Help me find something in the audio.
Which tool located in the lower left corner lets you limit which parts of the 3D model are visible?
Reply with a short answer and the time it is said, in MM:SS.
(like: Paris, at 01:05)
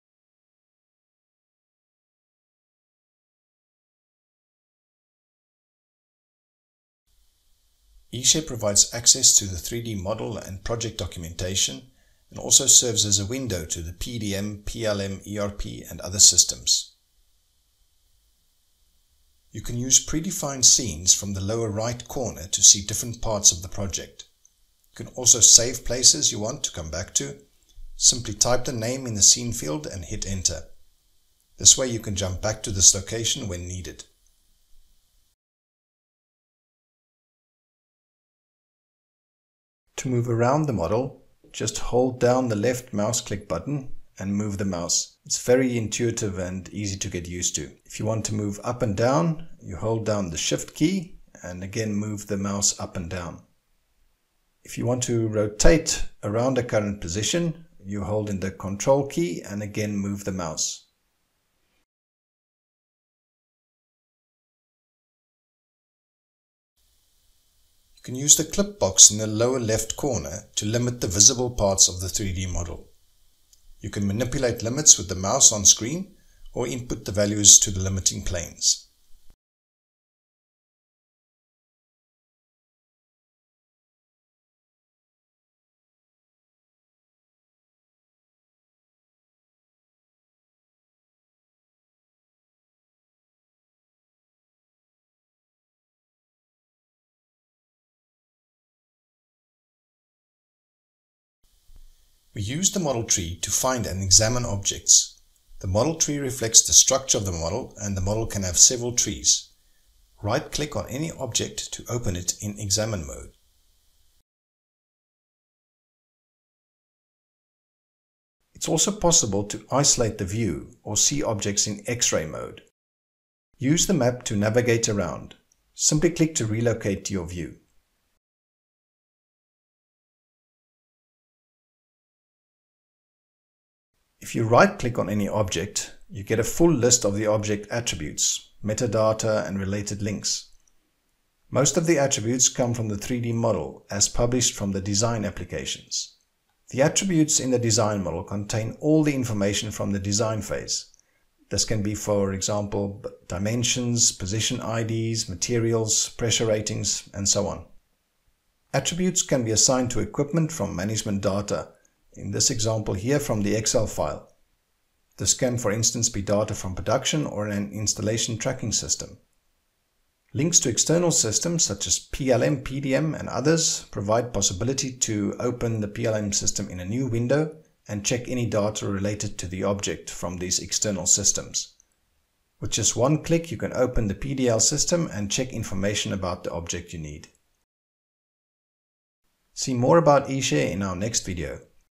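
Clip box, at 01:08.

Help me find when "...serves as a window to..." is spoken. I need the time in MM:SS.
00:12.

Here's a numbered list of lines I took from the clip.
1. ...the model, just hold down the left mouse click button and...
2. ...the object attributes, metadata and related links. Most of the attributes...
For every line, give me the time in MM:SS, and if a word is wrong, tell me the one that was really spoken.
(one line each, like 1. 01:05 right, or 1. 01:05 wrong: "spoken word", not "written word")
1. 00:40 right
2. 02:17 right.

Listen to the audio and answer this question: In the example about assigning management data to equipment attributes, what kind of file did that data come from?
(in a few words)
Excel file.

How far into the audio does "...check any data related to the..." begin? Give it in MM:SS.
02:58.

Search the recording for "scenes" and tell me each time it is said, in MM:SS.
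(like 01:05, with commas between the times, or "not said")
00:20, 00:29.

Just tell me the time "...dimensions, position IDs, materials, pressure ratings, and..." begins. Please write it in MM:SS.
02:33.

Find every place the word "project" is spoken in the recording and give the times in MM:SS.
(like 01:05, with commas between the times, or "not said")
00:10, 00:23.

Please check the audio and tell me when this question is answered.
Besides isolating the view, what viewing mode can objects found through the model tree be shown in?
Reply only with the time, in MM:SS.
02:01.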